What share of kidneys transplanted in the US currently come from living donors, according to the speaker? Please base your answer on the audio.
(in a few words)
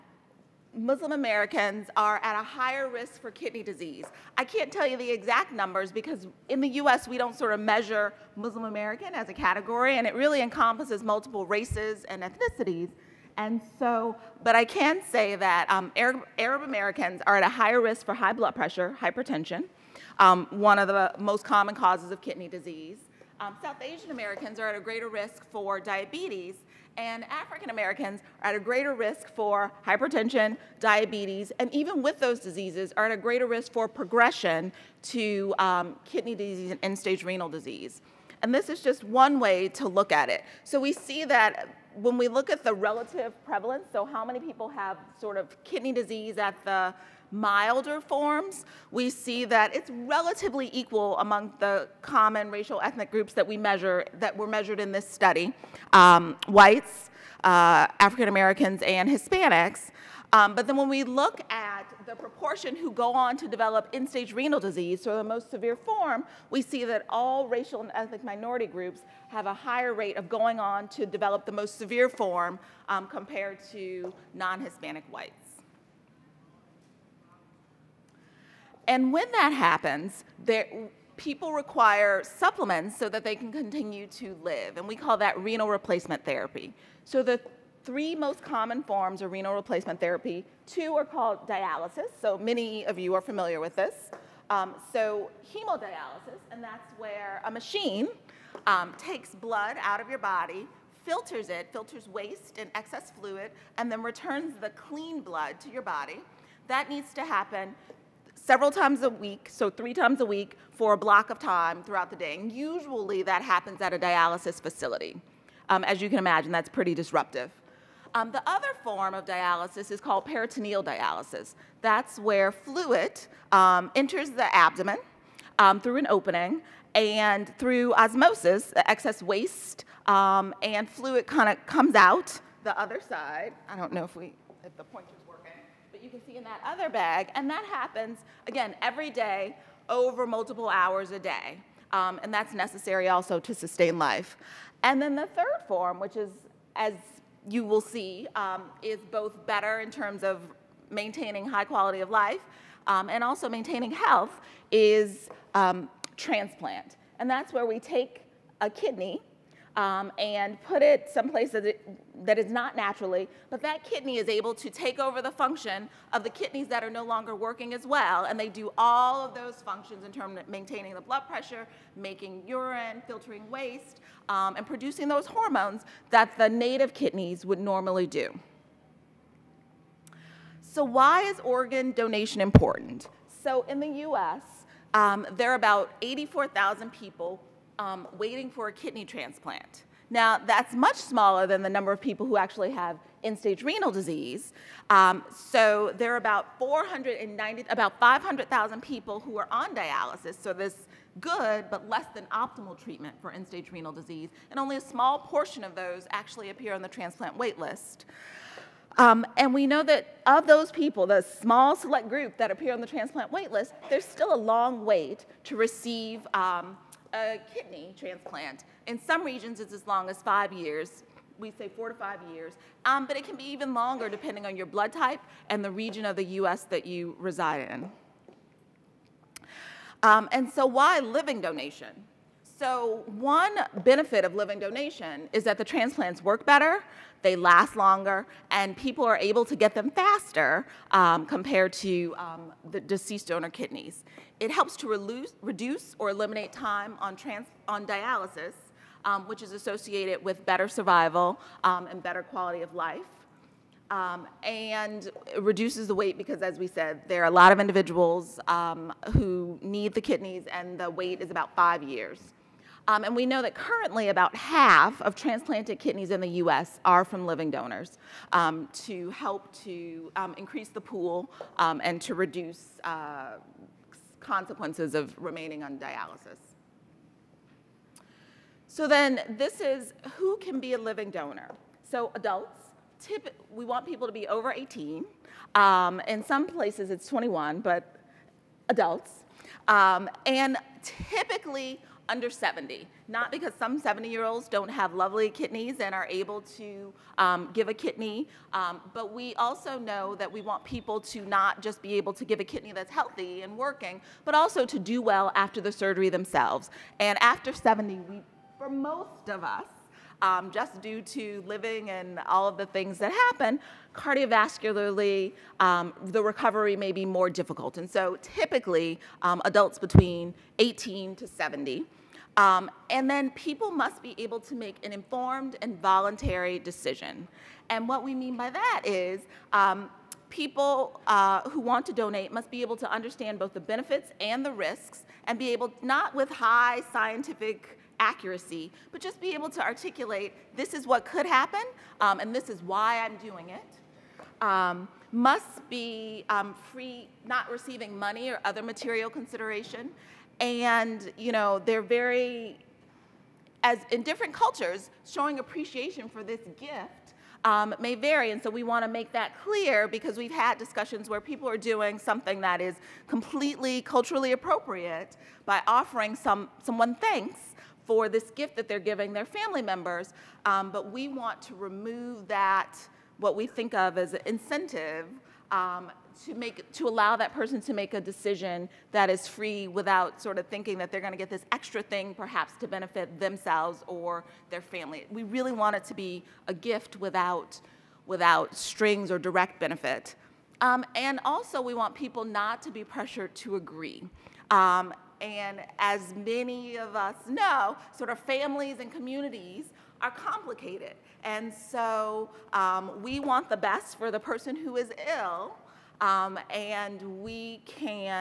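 about half.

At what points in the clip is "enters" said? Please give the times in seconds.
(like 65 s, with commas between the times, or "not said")
123 s.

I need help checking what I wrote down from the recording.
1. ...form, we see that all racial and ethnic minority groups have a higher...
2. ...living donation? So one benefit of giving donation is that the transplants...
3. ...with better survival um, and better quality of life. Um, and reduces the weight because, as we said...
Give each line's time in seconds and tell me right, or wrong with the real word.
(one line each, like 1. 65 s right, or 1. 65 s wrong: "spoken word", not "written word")
1. 65 s right
2. 231 s wrong: "living", not "giving"
3. 250 s right.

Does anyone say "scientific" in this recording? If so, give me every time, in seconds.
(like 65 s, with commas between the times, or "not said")
336 s.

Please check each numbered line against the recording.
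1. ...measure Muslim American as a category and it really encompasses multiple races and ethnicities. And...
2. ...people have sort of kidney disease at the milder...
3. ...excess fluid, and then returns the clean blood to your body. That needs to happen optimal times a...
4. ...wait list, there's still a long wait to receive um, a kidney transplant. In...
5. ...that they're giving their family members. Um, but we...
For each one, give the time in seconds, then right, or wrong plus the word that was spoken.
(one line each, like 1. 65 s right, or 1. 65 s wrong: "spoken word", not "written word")
1. 7 s right
2. 44 s right
3. 102 s wrong: "several", not "optimal"
4. 213 s right
5. 368 s right.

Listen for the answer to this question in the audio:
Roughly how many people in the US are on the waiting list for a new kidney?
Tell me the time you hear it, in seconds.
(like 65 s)
186 s.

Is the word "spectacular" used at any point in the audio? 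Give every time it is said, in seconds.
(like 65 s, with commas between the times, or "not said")
not said.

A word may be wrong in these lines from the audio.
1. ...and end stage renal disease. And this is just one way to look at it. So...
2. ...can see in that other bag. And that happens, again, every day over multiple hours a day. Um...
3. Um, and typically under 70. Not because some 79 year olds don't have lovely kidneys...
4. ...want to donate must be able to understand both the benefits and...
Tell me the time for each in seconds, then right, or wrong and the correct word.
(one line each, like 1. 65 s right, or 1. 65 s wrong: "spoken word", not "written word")
1. 36 s right
2. 136 s right
3. 289 s wrong: "70", not "79"
4. 331 s right.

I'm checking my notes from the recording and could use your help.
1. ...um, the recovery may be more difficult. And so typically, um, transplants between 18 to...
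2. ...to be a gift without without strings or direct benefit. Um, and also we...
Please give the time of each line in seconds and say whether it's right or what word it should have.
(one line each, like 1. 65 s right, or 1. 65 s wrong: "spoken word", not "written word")
1. 315 s wrong: "adults", not "transplants"
2. 385 s right.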